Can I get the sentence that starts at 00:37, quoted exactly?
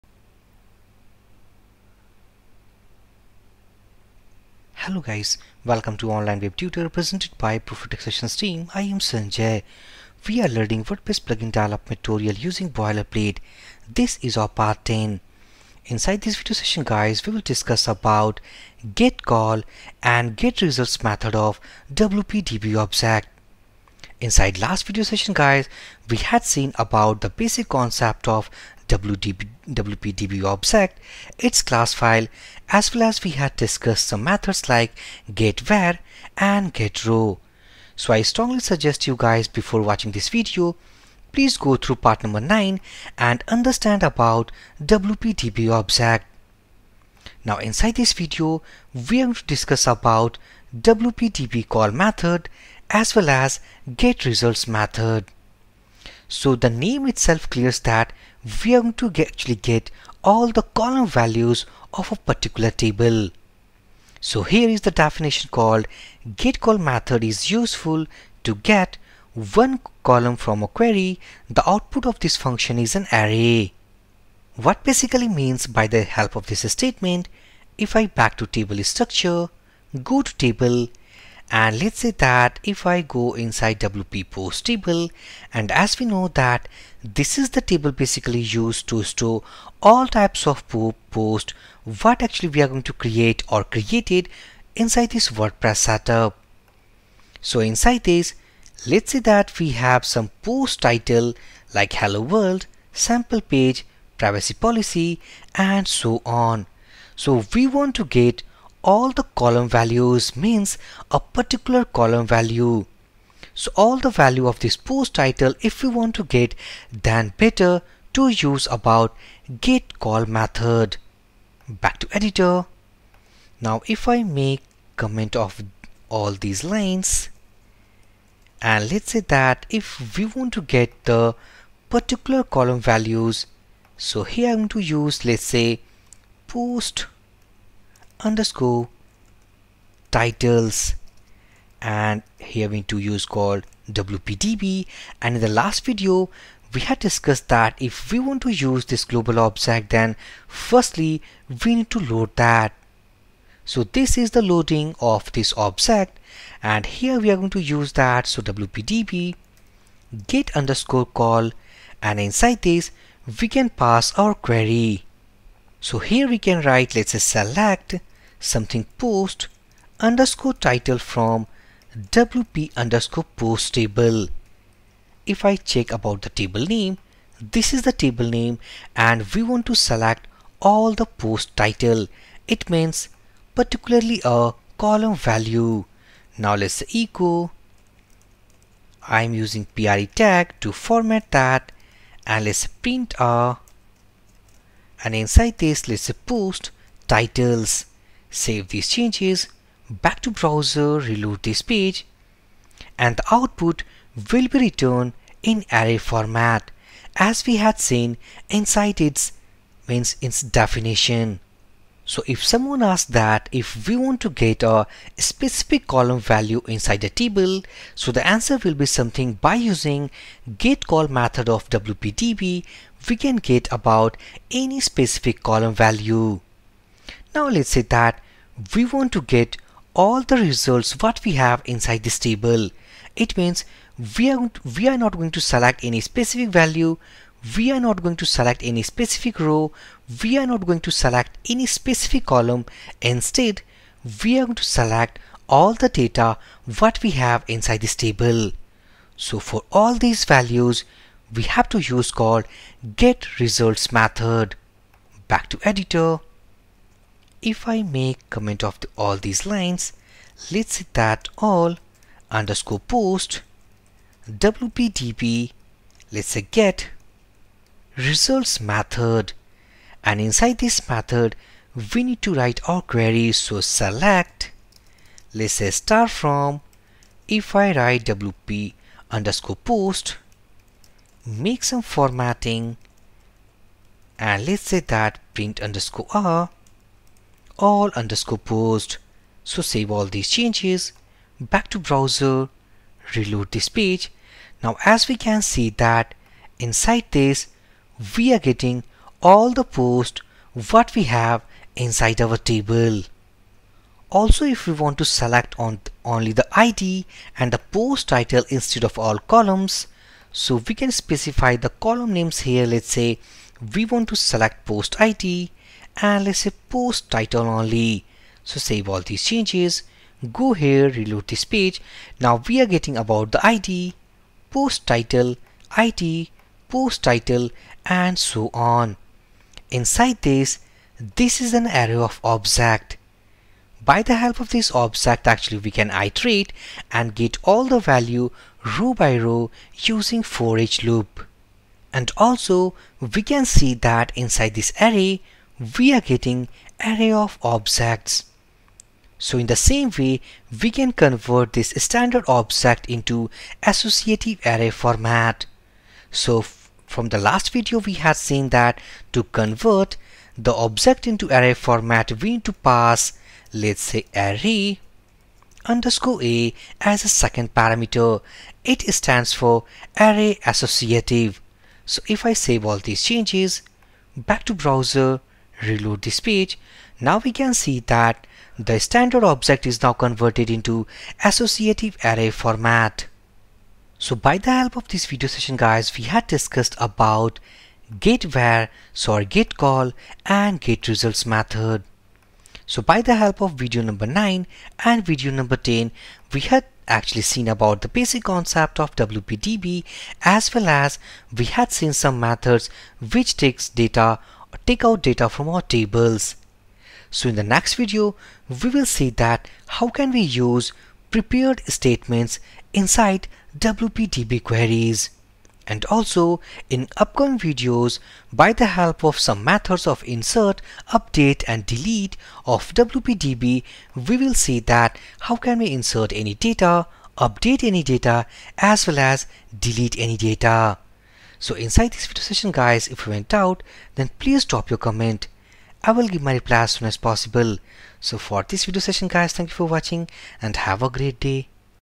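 So I strongly suggest you guys before watching this video, please go through part number 9 and understand about WPDB object.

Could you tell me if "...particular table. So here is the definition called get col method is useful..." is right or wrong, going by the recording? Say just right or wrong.
right.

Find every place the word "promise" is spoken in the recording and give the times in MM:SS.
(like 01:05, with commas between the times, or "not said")
not said.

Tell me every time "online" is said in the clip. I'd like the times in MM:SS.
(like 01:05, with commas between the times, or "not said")
00:06.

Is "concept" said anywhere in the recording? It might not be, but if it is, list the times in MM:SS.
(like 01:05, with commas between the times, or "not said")
00:27, 06:38.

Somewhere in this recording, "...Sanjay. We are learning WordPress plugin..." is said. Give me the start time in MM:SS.
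00:08.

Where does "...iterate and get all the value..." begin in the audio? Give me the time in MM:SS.
05:35.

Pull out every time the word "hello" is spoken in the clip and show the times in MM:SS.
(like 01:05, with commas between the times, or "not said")
00:04, 01:41.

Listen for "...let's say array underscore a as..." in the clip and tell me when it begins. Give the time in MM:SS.
06:03.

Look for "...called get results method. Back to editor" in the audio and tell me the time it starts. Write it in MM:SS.
04:12.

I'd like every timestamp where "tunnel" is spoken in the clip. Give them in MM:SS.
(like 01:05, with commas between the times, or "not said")
not said.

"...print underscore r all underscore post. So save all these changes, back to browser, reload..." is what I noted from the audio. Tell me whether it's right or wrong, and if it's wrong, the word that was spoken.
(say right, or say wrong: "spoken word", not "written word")
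right.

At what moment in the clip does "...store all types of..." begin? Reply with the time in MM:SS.
01:29.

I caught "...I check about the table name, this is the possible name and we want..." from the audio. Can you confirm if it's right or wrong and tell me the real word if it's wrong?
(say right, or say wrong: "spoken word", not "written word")
wrong: "table", not "possible".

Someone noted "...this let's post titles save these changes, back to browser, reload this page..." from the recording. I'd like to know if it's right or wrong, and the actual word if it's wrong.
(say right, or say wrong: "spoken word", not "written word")
right.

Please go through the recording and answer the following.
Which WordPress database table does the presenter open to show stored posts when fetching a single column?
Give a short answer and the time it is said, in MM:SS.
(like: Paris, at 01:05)
WP post, at 01:23.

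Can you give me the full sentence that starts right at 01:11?
The output of this function is an array.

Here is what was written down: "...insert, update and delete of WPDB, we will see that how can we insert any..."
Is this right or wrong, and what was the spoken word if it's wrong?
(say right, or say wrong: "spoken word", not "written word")
right.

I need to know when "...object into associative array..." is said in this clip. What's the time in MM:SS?
05:52.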